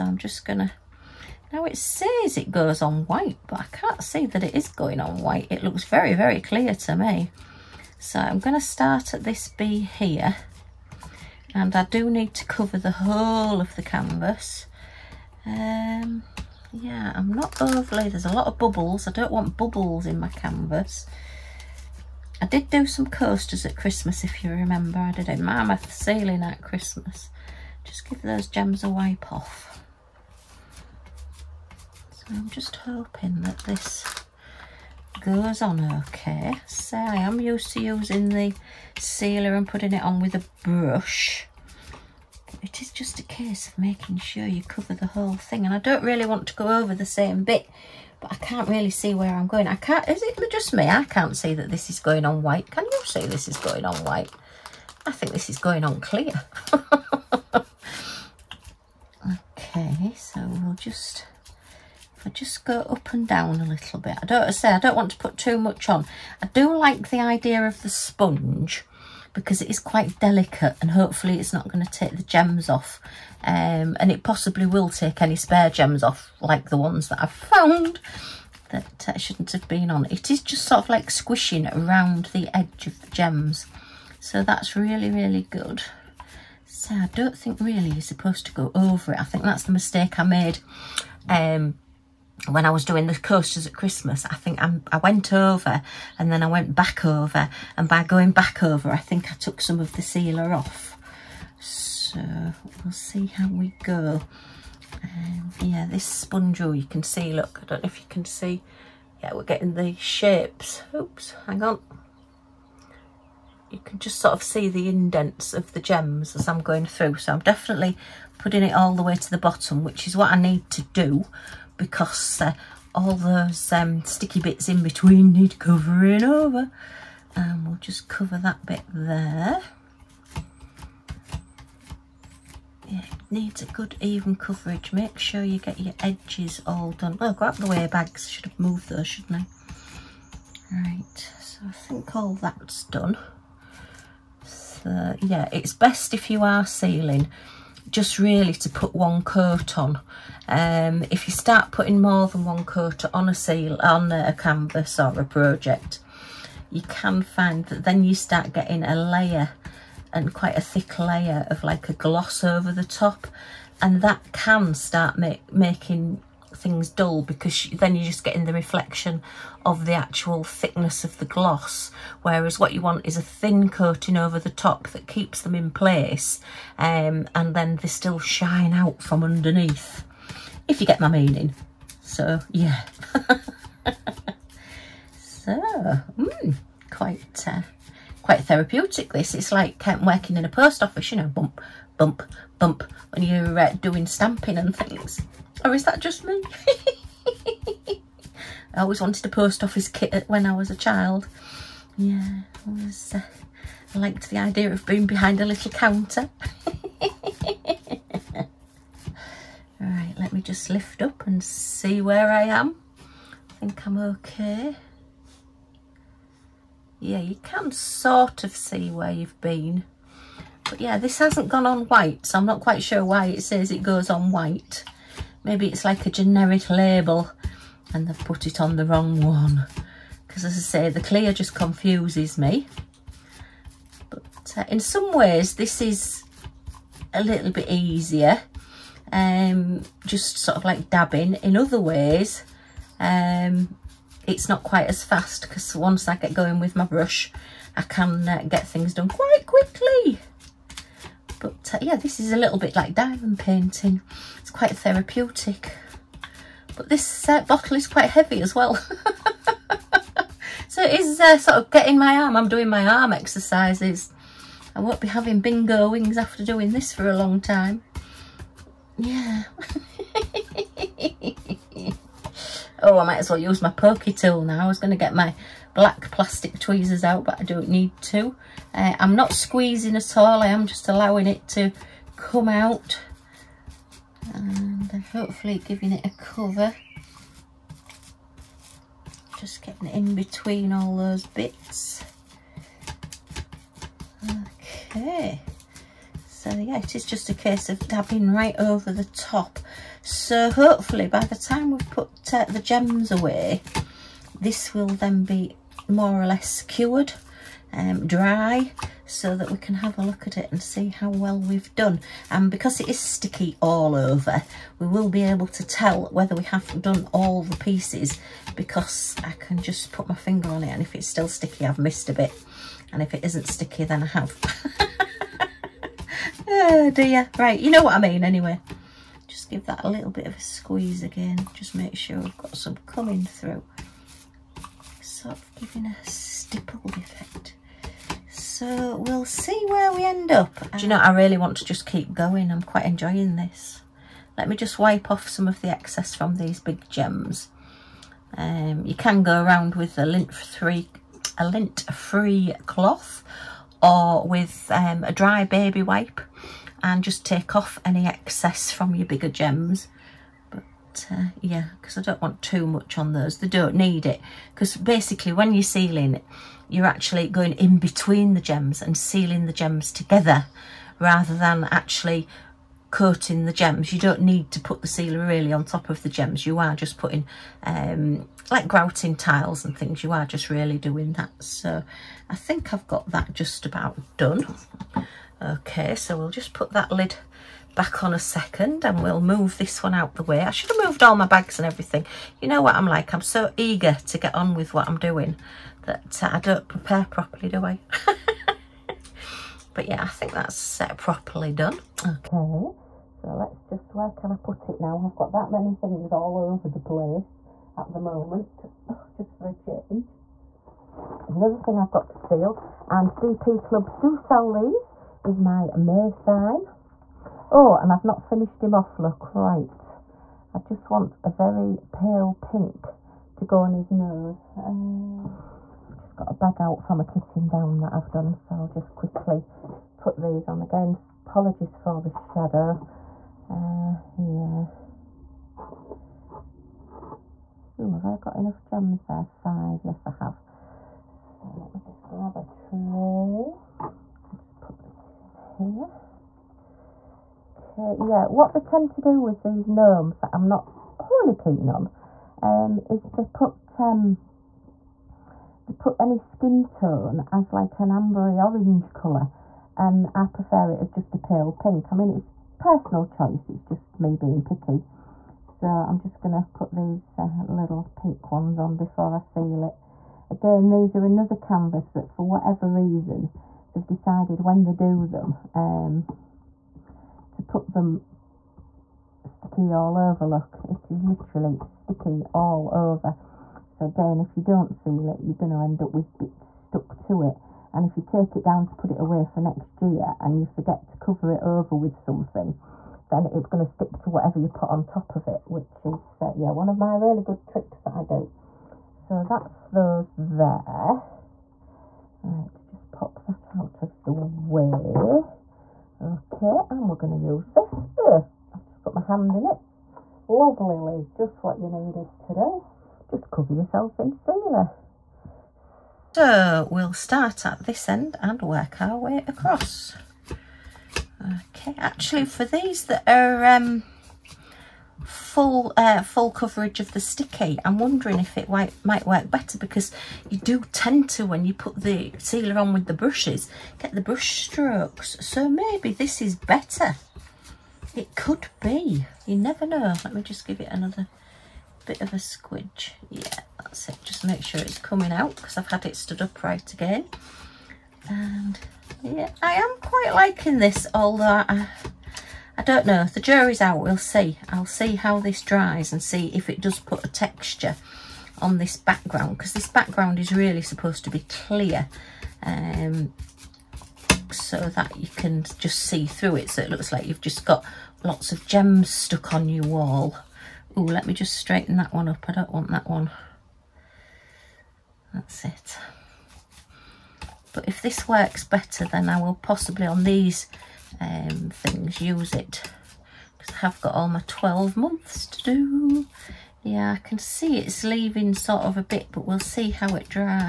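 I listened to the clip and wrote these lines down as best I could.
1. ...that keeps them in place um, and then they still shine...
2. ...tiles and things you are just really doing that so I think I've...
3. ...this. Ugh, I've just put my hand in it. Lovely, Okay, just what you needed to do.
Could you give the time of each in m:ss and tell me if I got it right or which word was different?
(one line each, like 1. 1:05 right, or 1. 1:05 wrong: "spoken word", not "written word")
1. 2:54 right
2. 6:19 right
3. 8:27 wrong: "Liz", not "Okay".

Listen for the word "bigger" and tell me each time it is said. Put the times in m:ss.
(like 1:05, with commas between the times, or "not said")
5:59.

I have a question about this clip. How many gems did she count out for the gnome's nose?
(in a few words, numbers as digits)
5.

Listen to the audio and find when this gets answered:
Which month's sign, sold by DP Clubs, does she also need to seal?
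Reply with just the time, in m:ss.
6:55.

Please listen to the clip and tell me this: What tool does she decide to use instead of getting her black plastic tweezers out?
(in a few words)
Pokey tool.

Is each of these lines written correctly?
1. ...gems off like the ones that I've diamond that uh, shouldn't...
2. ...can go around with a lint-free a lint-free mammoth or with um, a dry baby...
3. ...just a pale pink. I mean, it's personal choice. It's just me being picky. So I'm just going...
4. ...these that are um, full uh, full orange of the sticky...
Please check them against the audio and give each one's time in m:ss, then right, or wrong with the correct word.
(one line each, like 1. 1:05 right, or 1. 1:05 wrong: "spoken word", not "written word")
1. 1:15 wrong: "found", not "diamond"
2. 5:48 wrong: "cloth", not "mammoth"
3. 7:40 right
4. 8:42 wrong: "coverage", not "orange".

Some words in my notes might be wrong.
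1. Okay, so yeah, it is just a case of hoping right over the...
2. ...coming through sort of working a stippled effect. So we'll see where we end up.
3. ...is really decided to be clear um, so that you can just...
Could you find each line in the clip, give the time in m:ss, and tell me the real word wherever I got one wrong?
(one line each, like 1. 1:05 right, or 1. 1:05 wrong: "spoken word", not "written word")
1. 4:54 wrong: "dabbing", not "hoping"
2. 5:32 wrong: "giving", not "working"
3. 9:20 wrong: "supposed", not "decided".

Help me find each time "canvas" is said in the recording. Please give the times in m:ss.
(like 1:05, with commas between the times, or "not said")
0:13, 0:20, 2:34, 7:51.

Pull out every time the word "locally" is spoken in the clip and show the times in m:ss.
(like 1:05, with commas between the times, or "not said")
not said.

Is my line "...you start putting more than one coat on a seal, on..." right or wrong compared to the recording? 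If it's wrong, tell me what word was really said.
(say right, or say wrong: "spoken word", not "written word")
right.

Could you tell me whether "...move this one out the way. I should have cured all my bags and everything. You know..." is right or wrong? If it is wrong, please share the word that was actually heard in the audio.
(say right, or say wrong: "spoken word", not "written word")
wrong: "moved", not "cured".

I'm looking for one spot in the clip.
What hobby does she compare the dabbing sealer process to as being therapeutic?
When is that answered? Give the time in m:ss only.
4:12.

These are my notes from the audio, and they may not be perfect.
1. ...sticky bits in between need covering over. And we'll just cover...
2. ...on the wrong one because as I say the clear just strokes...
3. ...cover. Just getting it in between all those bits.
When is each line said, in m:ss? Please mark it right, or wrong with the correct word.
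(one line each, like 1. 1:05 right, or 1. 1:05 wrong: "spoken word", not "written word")
1. 2:04 right
2. 3:48 wrong: "confuses", not "strokes"
3. 4:46 right.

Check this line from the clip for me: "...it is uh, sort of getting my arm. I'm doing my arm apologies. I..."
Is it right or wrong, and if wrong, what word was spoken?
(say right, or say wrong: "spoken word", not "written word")
wrong: "exercises", not "apologies".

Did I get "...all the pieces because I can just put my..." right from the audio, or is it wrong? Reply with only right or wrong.
right.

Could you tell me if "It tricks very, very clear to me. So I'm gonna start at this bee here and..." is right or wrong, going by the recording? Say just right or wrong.
wrong.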